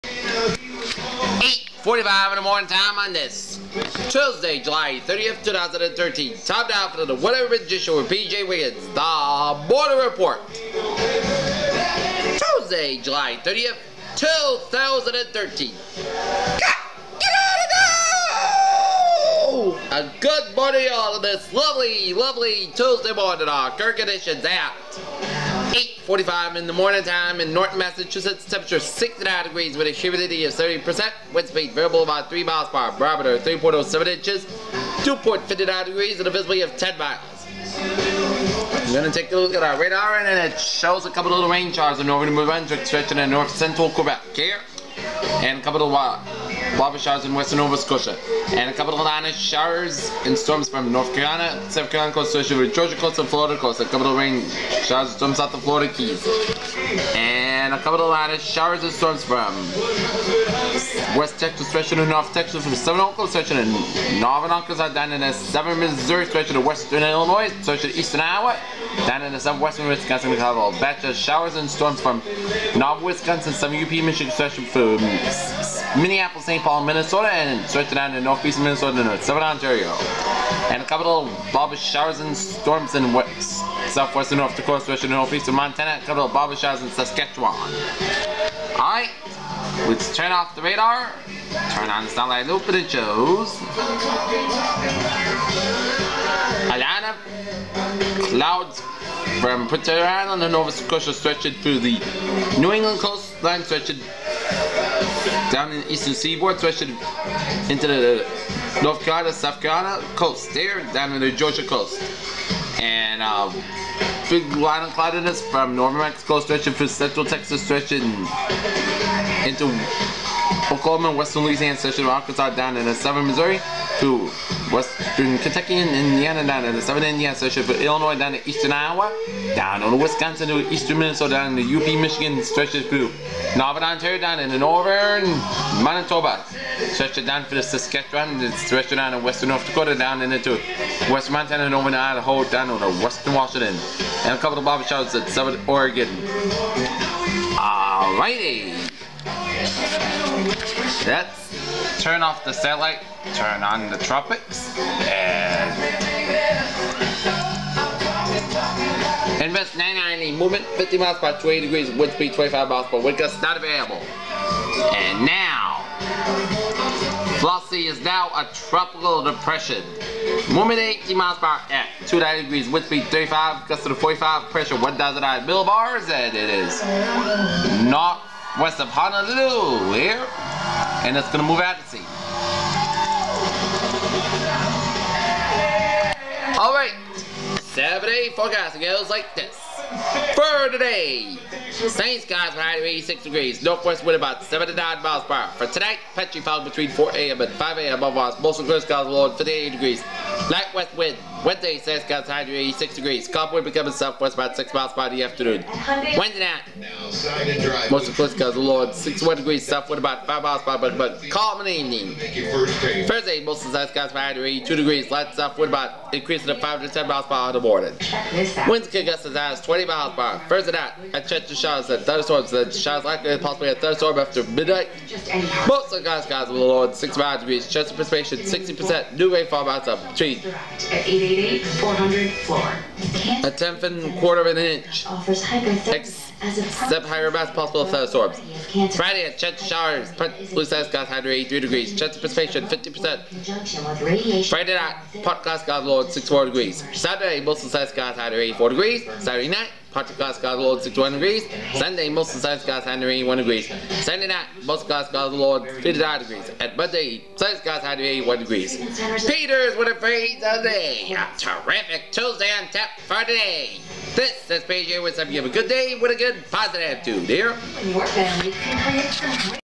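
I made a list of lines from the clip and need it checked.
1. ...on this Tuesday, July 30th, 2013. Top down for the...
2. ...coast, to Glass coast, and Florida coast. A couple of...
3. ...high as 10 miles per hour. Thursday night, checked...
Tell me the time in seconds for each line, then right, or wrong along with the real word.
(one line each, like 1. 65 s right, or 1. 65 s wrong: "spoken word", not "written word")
1. 2 s right
2. 52 s wrong: "Georgia", not "Glass"
3. 219 s wrong: "20", not "10".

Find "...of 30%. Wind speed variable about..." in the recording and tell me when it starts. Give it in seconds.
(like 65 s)
30 s.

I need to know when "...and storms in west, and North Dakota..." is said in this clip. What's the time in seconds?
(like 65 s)
82 s.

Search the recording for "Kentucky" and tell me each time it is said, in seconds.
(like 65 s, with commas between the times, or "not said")
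125 s.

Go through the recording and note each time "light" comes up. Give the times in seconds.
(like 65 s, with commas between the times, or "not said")
200 s, 215 s.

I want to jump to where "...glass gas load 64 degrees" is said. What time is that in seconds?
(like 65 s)
245 s.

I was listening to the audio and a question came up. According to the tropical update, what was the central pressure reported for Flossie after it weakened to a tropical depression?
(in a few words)
1,009 millibars.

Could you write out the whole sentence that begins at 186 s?
Alright, right, seven-day forecast goes like this.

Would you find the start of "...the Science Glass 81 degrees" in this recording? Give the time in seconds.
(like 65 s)
252 s.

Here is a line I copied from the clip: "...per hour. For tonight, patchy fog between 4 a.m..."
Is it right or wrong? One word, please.
right.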